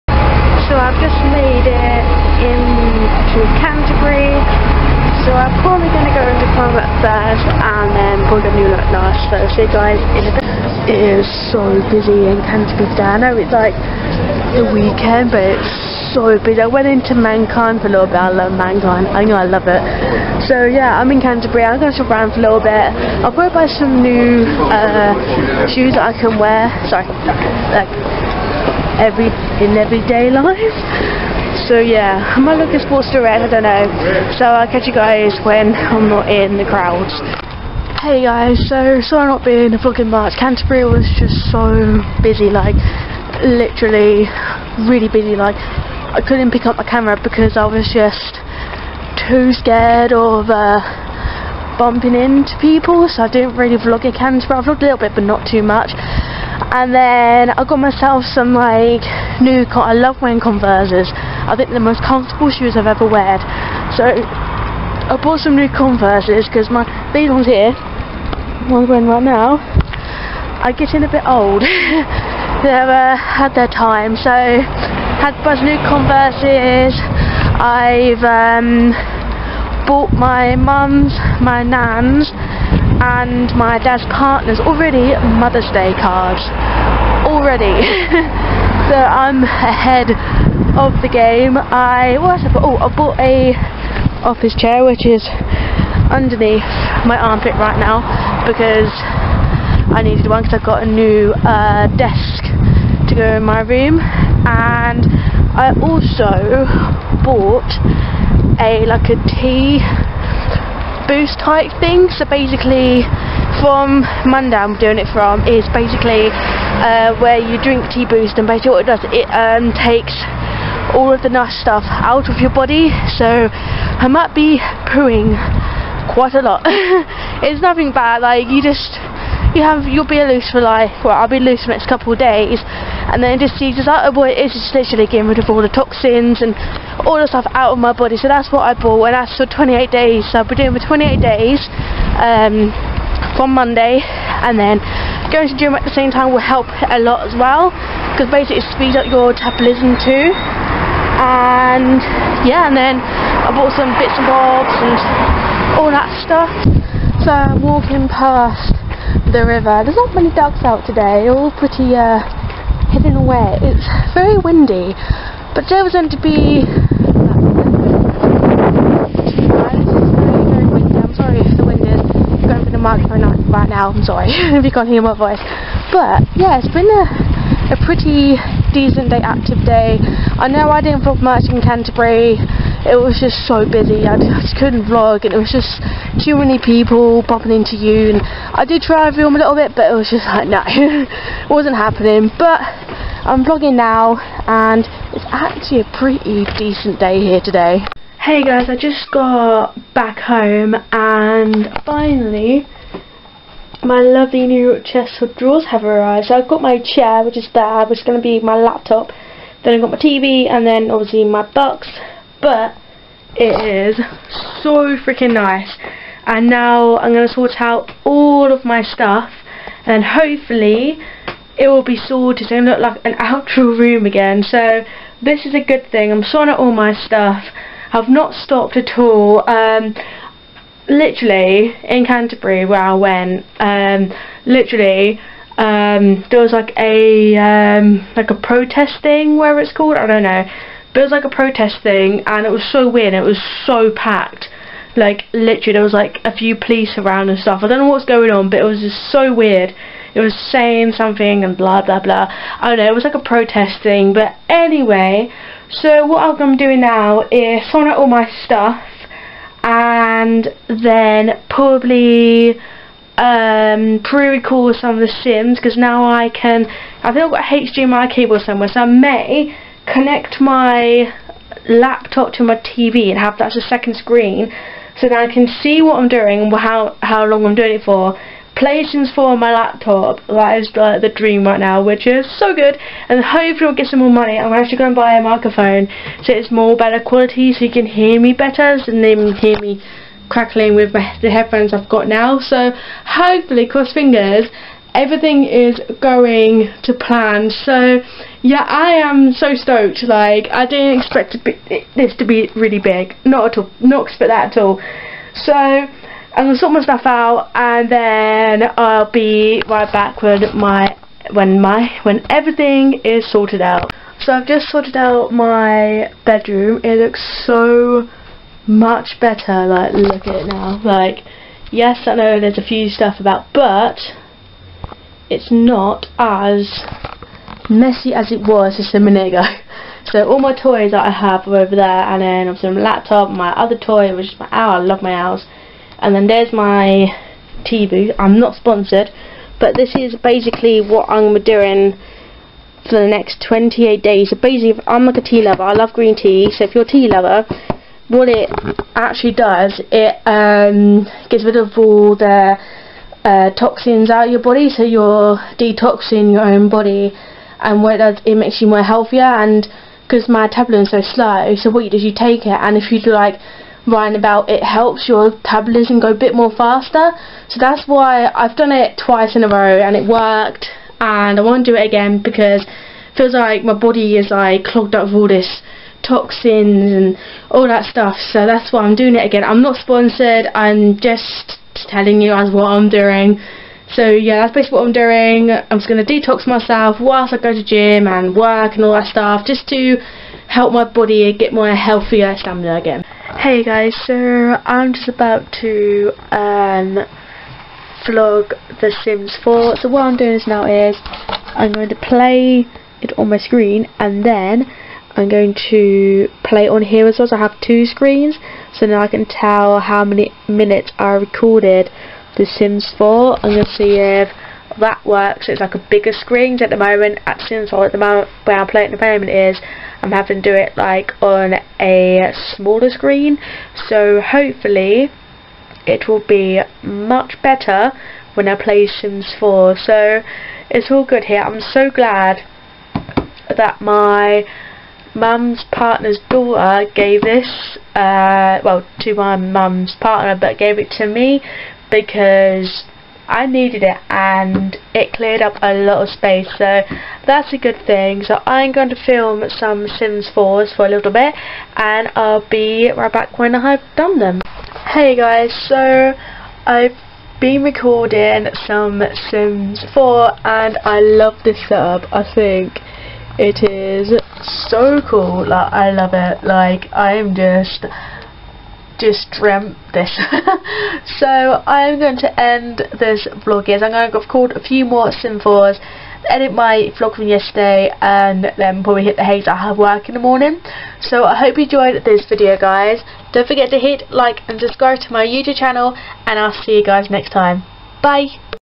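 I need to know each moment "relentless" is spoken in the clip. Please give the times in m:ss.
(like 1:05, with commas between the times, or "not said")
not said.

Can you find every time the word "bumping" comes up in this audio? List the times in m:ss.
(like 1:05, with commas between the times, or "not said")
0:51, 3:07.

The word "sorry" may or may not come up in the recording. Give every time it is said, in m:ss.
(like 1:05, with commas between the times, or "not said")
0:26, 0:39, 2:54.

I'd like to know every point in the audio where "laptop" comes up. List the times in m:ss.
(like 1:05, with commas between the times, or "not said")
3:28, 4:31, 4:39, 5:32.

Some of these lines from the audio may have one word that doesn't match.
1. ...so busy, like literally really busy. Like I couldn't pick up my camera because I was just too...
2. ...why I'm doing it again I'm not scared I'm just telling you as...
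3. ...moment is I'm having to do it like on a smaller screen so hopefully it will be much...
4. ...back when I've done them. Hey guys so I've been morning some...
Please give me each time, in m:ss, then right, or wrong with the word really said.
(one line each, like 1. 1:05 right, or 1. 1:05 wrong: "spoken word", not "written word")
1. 0:41 right
2. 6:18 wrong: "sponsored", not "scared"
3. 6:59 right
4. 7:33 wrong: "recording", not "morning".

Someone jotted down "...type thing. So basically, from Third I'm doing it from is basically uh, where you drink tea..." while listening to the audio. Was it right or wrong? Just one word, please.
wrong.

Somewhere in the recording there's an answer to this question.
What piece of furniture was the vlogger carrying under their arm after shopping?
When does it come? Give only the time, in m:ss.
1:34.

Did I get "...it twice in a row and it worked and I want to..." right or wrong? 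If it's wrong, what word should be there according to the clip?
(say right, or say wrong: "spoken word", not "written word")
right.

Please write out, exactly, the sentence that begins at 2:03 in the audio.
So I might be pooing quite a lot.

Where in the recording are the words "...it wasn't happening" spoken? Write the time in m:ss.
3:10.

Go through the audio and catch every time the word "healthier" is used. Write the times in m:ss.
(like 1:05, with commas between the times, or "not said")
5:58, 6:31.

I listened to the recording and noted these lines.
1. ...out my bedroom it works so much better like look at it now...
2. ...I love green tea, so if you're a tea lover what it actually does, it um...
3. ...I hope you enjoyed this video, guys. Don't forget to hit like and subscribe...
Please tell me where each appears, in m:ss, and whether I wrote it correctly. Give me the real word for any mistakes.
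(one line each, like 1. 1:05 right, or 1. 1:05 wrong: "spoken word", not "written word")
1. 5:14 wrong: "looks", not "works"
2. 5:45 right
3. 8:01 right.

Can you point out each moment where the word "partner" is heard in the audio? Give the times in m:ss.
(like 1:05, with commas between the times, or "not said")
1:24, 7:15, 7:19.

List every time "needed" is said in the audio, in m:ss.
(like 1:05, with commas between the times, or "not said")
1:40, 7:23.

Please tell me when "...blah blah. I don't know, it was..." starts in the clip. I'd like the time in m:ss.
4:11.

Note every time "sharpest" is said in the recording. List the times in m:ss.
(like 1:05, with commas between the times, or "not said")
not said.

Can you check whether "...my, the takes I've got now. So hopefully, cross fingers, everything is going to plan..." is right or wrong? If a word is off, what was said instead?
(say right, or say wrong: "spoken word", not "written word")
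wrong: "headphones", not "takes".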